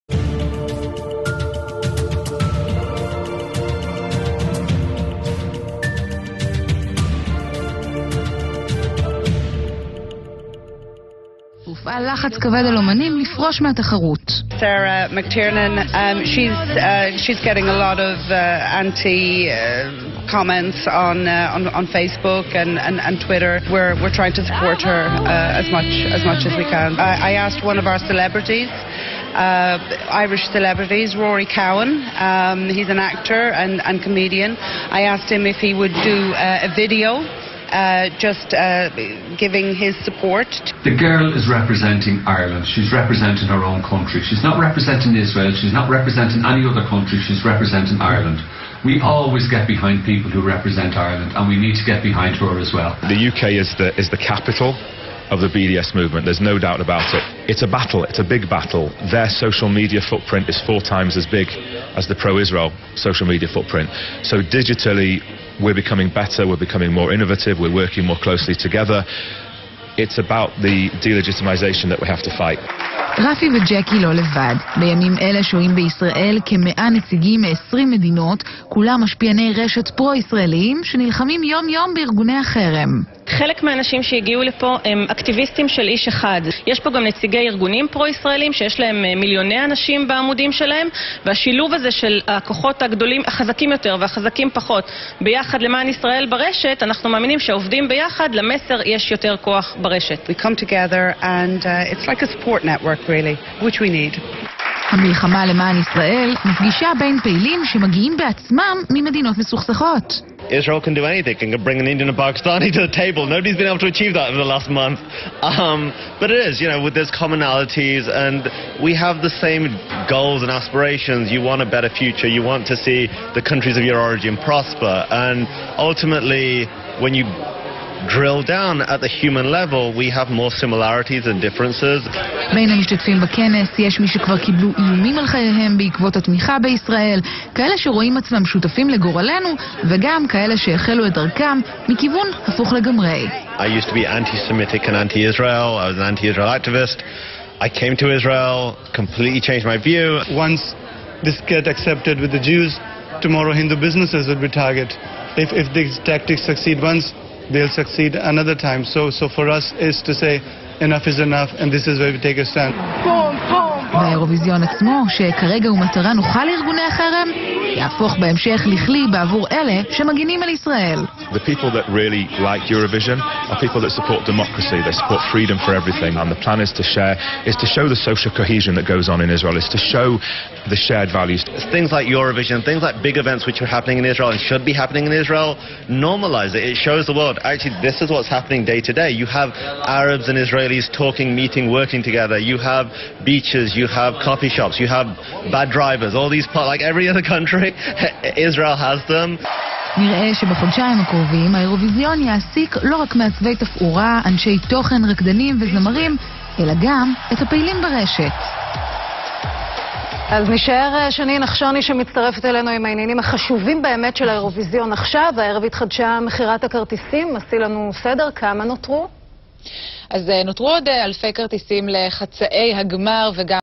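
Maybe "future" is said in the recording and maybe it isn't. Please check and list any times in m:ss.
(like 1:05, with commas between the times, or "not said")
2:01.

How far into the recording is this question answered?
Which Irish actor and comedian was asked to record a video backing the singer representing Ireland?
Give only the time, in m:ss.
0:31.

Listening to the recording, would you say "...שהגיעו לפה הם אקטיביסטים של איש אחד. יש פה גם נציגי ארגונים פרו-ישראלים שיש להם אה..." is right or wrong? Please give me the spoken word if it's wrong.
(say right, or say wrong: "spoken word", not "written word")
right.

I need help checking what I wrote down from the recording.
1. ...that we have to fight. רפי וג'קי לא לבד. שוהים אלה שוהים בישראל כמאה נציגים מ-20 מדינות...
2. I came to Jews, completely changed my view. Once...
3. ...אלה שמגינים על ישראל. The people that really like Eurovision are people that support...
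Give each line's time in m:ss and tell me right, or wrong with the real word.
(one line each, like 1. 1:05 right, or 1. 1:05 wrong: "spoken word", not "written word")
1. 1:11 wrong: "בימים", not "שוהים"
2. 2:27 wrong: "Israel", not "Jews"
3. 2:49 right.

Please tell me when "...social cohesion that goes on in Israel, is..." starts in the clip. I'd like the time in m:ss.
2:58.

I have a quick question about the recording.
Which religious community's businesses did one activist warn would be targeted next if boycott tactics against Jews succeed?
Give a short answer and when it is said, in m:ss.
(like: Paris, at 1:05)
Hindu, at 2:33.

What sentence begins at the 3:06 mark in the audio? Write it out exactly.
It shows the world, actually, this is what's happening day to day.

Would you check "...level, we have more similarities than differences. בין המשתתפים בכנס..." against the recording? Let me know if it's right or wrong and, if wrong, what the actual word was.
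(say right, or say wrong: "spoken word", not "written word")
right.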